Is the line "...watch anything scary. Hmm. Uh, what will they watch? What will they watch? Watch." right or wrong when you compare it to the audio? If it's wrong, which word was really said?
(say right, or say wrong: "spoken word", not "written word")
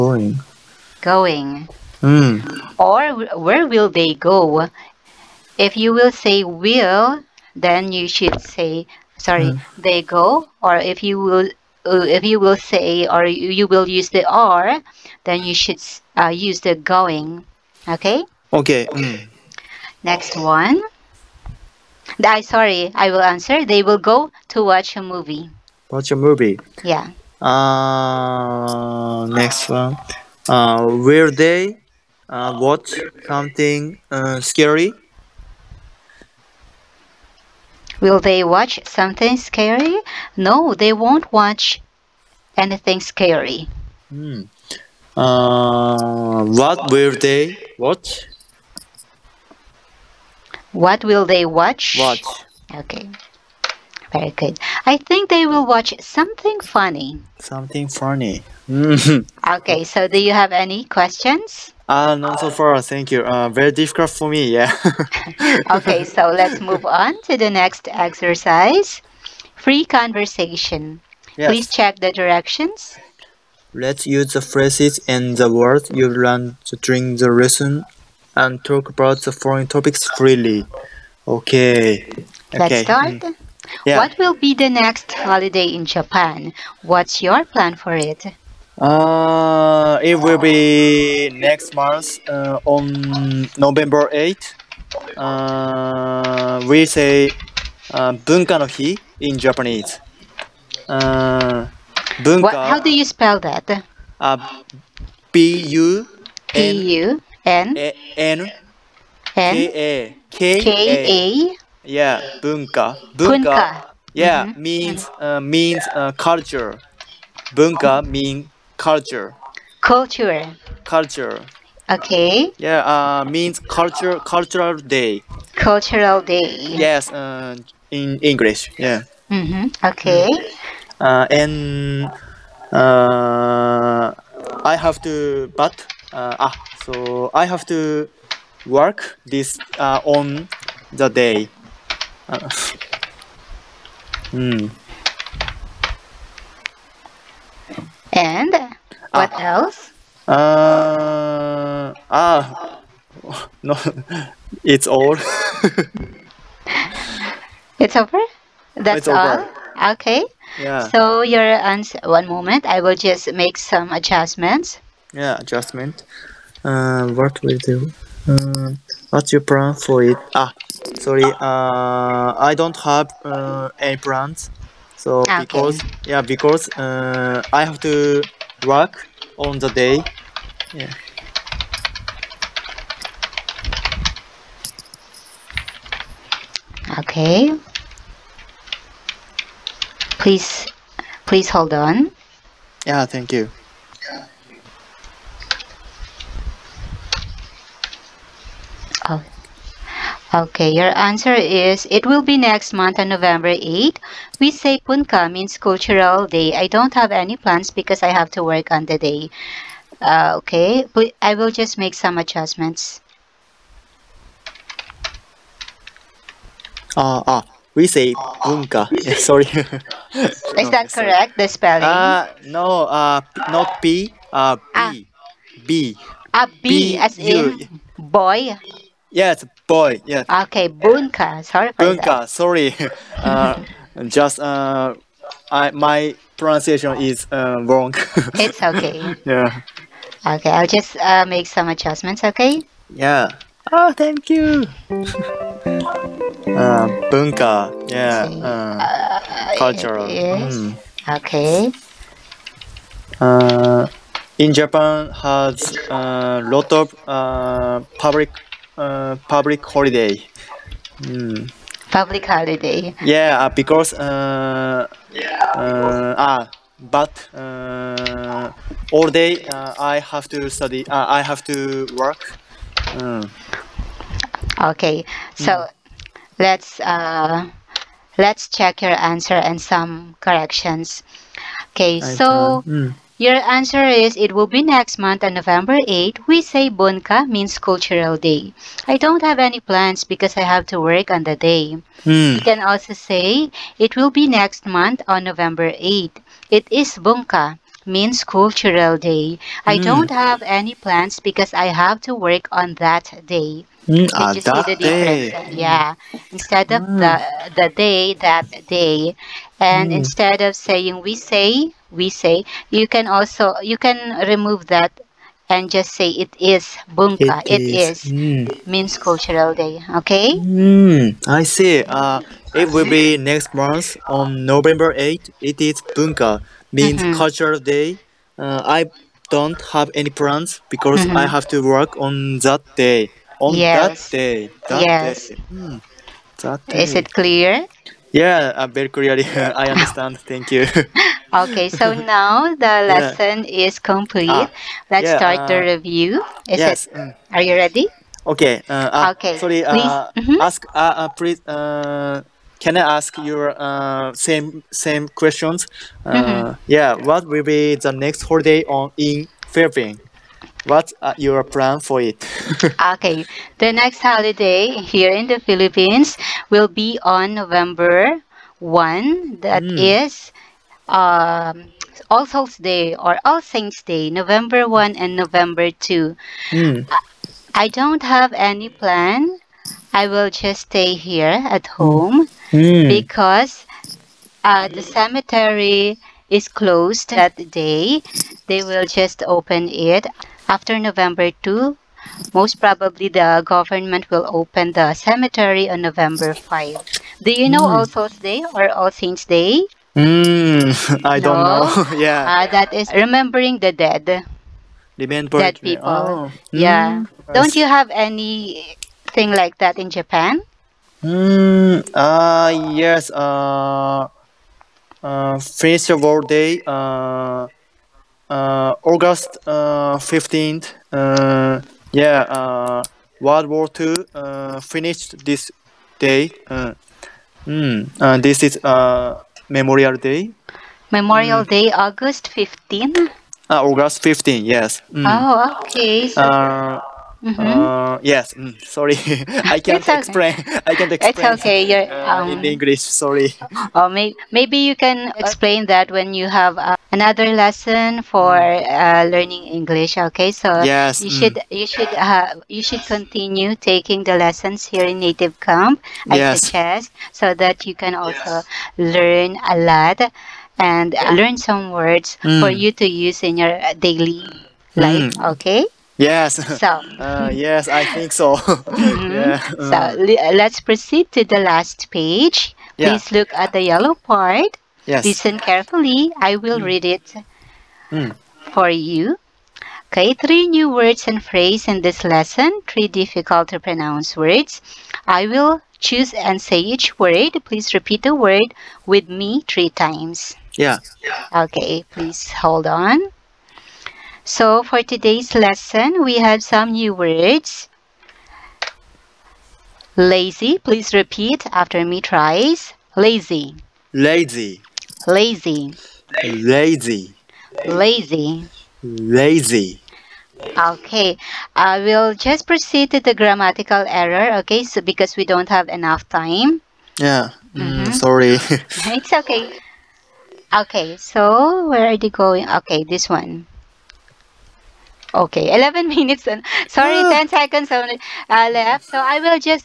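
right.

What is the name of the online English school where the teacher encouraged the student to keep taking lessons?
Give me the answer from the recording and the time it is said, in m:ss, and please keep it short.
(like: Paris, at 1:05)
Native Camp, at 7:35.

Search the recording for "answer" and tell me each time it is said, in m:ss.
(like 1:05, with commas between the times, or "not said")
0:23, 2:41, 3:20, 4:38, 4:43.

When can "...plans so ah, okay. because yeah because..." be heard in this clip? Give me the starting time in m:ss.
2:53.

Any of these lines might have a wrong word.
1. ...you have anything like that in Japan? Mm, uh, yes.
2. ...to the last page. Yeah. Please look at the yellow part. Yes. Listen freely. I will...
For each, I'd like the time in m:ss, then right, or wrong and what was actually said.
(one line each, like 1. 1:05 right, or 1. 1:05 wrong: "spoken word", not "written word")
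1. 6:47 right
2. 7:51 wrong: "carefully", not "freely".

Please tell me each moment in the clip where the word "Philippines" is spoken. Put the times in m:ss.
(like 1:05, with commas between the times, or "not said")
5:59, 6:05.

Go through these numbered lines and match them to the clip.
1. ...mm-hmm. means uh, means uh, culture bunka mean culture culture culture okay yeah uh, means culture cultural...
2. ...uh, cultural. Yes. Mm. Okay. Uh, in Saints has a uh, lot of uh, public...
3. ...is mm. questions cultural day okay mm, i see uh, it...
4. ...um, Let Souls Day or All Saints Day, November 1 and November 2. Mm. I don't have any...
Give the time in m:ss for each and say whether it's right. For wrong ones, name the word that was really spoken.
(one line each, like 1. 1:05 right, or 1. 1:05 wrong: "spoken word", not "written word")
1. 1:54 right
2. 4:08 wrong: "Japan", not "Saints"
3. 5:18 wrong: "means", not "questions"
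4. 6:10 wrong: "All", not "Let".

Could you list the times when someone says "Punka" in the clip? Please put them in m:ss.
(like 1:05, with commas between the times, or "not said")
3:24, 3:38.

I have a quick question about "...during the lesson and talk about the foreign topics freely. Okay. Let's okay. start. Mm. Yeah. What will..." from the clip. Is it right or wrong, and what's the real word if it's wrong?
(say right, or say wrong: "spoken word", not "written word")
right.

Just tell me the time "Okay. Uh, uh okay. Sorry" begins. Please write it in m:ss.
5:48.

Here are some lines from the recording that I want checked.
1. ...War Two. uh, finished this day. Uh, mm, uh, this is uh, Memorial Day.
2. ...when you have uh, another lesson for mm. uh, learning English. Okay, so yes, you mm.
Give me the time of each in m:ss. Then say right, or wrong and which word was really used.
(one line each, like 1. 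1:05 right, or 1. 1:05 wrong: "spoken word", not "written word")
1. 7:03 right
2. 7:25 right.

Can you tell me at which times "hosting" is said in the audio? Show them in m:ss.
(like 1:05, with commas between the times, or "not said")
not said.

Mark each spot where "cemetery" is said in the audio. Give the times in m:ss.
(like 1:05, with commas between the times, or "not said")
6:24, 6:34.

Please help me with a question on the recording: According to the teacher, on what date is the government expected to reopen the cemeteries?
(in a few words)
November 5.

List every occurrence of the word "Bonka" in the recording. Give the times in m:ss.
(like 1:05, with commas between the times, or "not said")
4:46, 4:56.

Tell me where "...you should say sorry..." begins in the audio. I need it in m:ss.
0:07.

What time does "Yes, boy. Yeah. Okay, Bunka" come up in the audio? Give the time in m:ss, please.
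3:49.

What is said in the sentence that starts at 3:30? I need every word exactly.
Uh, okay, but I will just make some adjustments.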